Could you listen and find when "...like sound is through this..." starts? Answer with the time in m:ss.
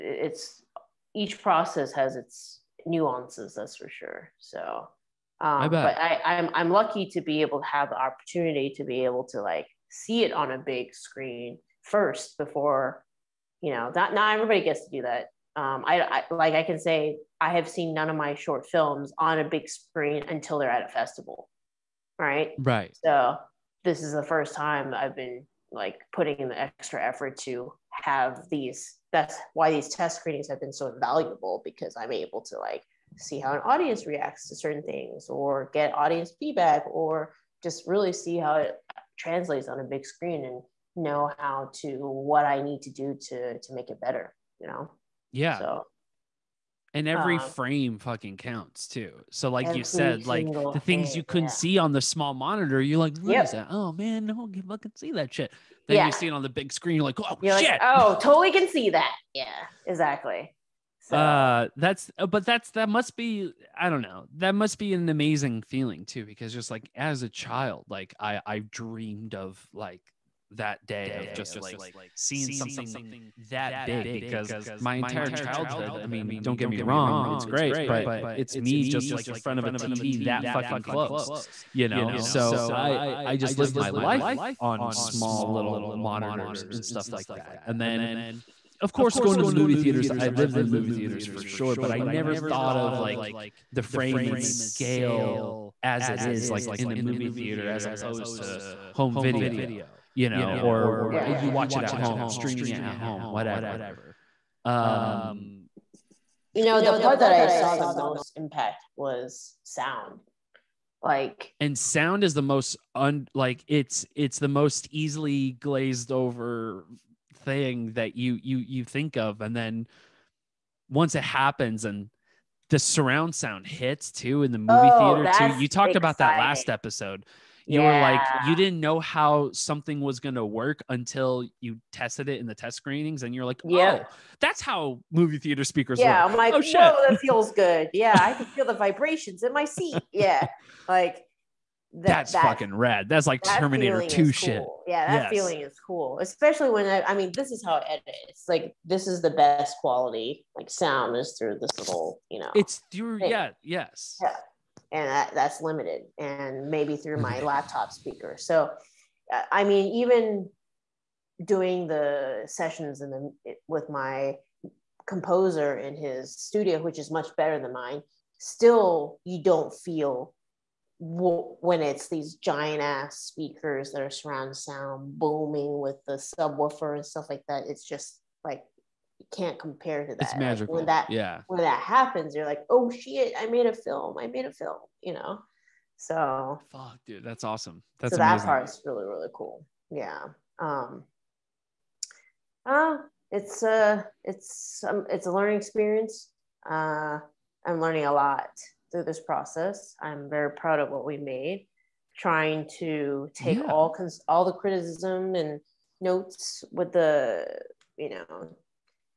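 2:30.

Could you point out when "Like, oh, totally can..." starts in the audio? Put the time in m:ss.
0:57.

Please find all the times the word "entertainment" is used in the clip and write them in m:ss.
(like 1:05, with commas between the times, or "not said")
not said.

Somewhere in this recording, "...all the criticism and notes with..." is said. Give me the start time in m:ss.
3:24.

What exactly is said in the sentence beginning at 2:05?
about that last episode you yeah.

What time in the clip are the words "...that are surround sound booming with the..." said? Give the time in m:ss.
2:53.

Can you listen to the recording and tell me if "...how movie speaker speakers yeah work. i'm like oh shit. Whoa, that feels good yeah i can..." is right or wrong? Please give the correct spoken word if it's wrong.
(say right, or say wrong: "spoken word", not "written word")
wrong: "theater", not "speaker".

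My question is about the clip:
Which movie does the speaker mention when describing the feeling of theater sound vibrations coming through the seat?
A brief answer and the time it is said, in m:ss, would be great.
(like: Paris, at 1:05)
Terminator 2, at 2:23.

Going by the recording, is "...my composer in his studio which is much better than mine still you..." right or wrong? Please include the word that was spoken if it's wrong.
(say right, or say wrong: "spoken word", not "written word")
right.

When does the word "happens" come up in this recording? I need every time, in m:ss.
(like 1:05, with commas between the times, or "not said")
2:01, 3:01.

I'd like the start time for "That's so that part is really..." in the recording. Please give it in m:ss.
3:07.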